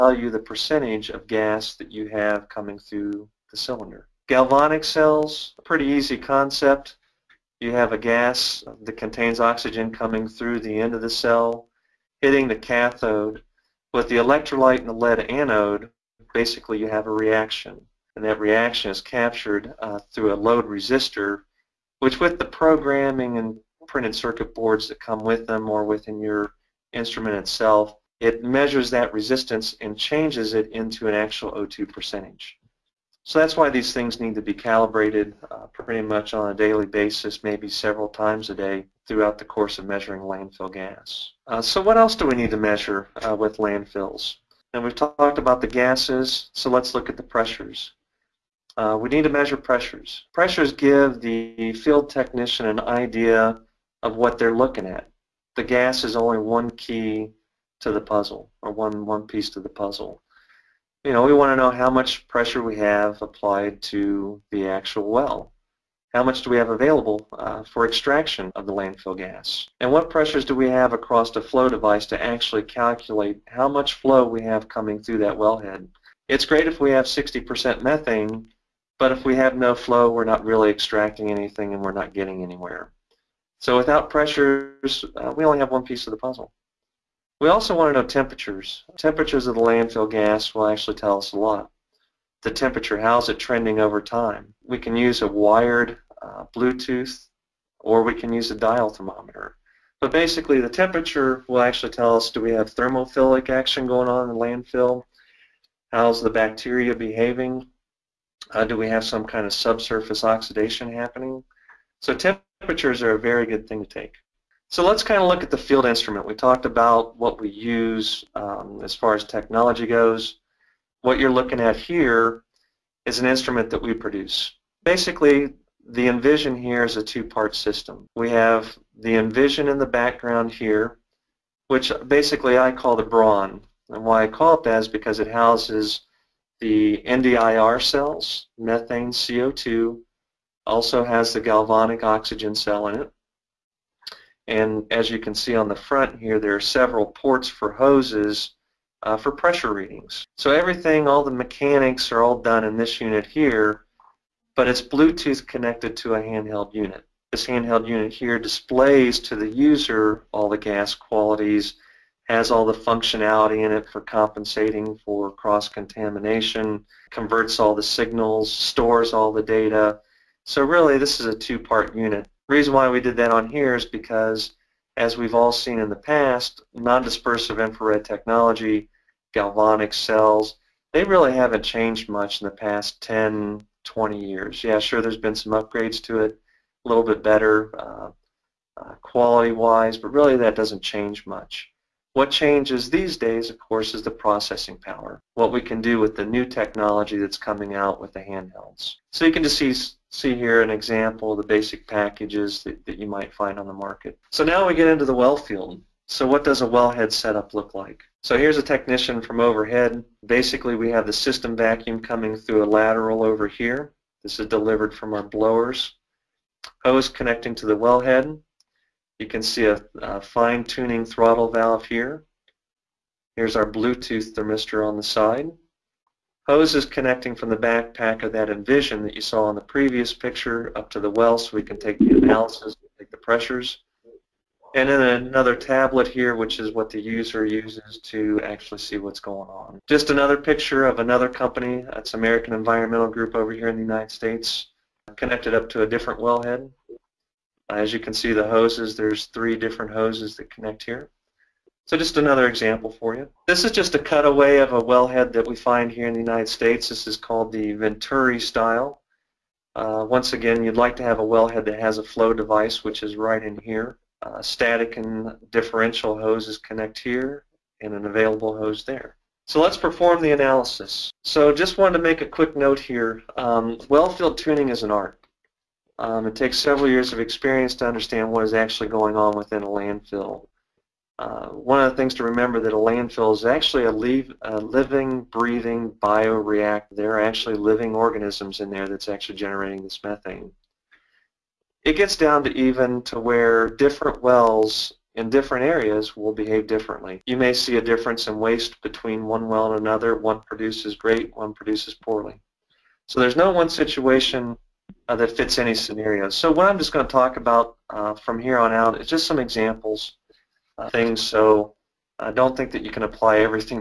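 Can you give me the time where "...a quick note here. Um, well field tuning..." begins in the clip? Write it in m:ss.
4:32.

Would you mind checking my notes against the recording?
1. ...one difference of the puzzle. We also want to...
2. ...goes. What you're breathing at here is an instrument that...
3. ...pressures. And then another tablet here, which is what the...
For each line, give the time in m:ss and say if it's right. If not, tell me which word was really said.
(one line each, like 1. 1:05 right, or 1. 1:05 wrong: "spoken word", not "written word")
1. 1:25 wrong: "piece", not "difference"
2. 1:59 wrong: "looking", not "breathing"
3. 3:53 right.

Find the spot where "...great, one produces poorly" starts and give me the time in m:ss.
5:00.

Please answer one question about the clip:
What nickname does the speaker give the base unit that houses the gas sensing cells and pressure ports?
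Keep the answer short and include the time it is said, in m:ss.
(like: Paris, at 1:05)
The brawn, at 2:12.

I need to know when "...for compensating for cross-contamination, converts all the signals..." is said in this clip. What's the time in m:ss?
2:43.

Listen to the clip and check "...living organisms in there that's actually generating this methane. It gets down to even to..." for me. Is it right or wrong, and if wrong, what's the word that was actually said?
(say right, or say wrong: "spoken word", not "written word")
right.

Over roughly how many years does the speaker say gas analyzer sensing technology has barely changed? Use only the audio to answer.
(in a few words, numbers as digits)
10 to 20 years.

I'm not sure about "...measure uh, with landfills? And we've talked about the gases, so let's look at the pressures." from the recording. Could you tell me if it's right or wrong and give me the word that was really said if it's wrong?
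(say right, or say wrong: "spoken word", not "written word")
right.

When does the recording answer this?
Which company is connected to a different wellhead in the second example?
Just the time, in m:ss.
4:02.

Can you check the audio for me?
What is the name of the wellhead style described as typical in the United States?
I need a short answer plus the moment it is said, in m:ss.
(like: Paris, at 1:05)
Venturi, at 4:17.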